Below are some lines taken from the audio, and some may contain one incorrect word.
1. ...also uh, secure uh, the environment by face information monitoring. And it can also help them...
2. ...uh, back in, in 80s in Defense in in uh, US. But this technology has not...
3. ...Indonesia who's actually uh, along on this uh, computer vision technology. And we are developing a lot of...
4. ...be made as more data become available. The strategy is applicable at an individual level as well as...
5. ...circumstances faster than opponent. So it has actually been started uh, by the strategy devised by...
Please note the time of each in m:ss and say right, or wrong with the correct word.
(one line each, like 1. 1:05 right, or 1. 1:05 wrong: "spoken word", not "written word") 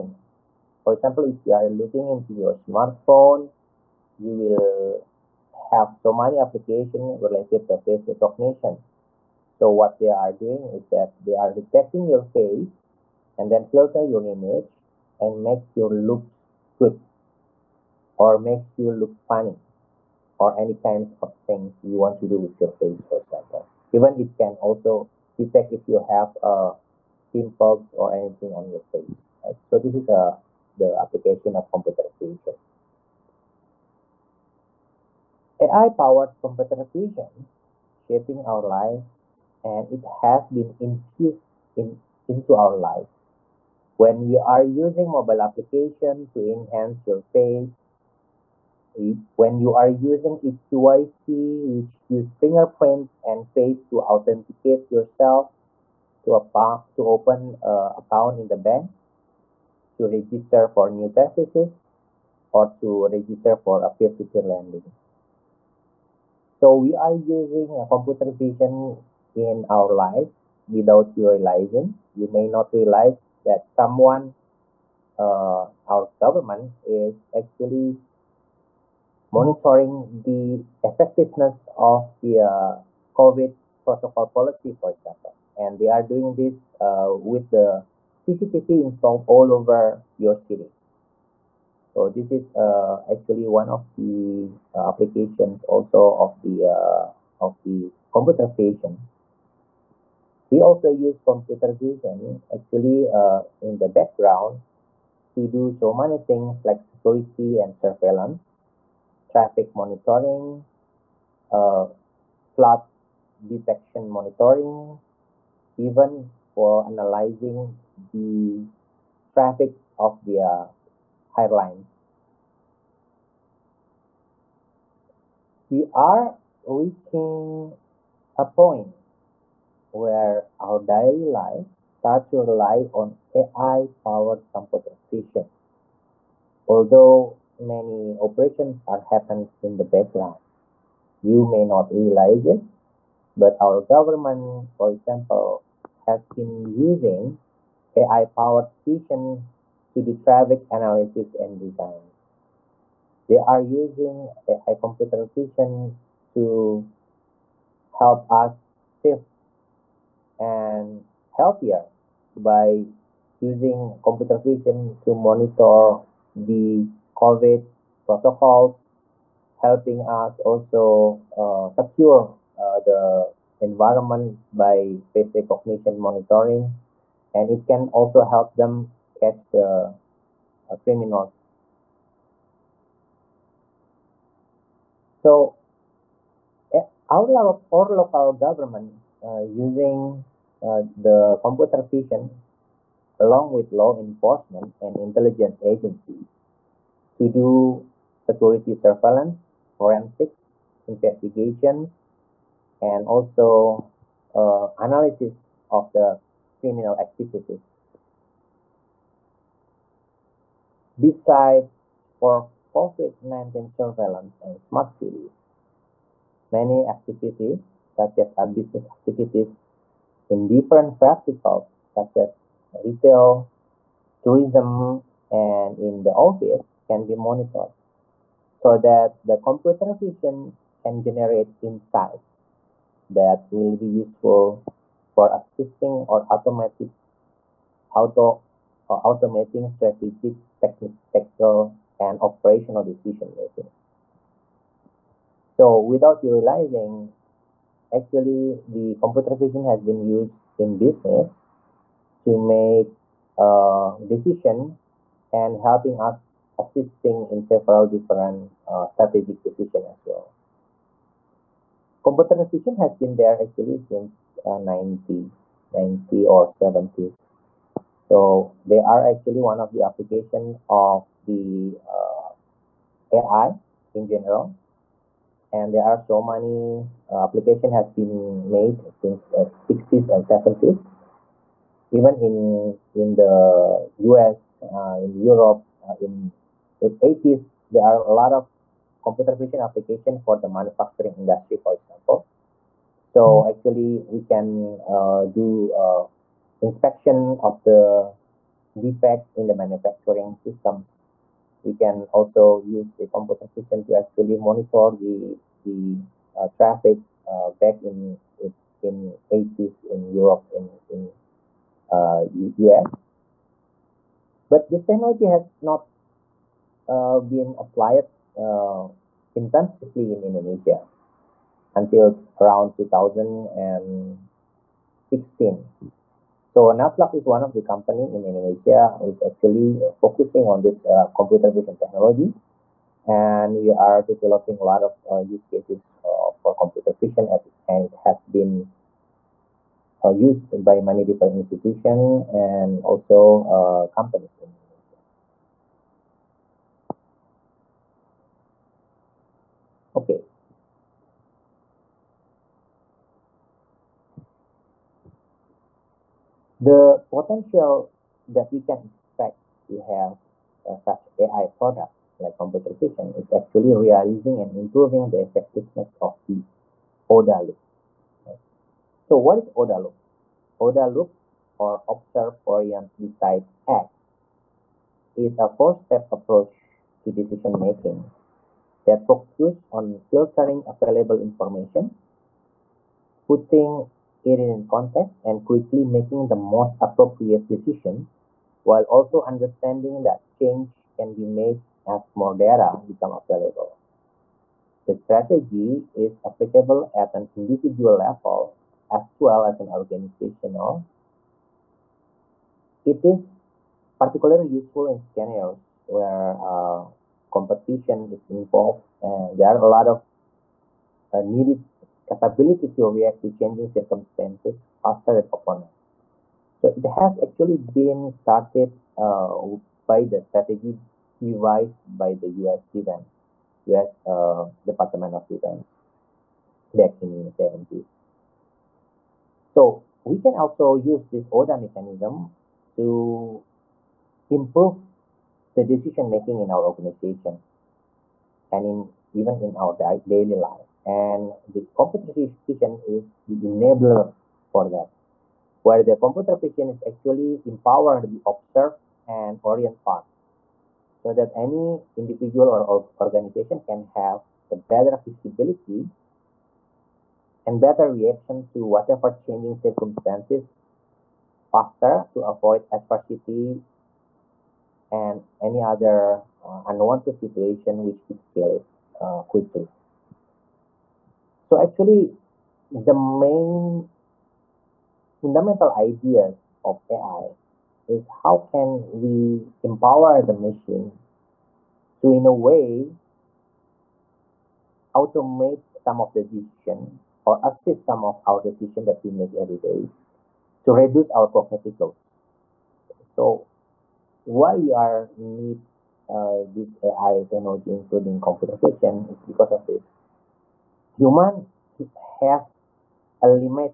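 1. 2:50 wrong: "recognition", not "information"
2. 5:07 wrong: "Europe", not "Defense"
3. 5:28 wrong: "focusing", not "along"
4. 6:31 right
5. 6:53 right.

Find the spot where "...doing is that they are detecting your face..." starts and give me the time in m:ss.
0:10.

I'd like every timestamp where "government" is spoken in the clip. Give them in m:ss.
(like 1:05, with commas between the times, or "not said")
1:16, 2:23, 3:08.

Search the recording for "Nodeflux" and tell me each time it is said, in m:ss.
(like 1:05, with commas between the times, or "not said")
5:26.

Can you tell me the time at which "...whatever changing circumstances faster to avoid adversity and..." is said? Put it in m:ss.
7:38.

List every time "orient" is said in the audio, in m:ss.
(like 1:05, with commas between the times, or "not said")
6:12, 7:29.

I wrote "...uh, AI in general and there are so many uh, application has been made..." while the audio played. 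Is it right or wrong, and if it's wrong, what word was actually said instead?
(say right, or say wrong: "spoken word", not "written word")
right.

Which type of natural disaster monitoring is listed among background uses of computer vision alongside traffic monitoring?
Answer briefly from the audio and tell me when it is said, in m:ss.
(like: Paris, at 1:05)
flood detection, at 1:52.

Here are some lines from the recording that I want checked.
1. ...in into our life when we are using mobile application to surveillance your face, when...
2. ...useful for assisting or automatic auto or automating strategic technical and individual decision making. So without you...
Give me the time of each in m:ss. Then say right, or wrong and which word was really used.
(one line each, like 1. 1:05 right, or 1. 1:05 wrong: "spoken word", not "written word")
1. 0:41 wrong: "enhance", not "surveillance"
2. 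3:53 wrong: "operational", not "individual".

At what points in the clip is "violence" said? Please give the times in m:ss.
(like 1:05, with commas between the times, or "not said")
not said.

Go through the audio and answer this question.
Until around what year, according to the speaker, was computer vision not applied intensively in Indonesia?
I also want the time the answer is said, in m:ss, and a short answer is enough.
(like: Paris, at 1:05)
2016, at 5:22.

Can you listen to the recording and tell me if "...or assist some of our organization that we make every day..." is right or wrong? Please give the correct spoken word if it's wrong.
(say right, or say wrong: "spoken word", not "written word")
wrong: "decision", not "organization".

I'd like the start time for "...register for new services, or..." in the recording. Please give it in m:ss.
1:00.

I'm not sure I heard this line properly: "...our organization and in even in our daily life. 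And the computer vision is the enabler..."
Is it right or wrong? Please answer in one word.
right.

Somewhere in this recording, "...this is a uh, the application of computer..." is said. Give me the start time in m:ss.
0:29.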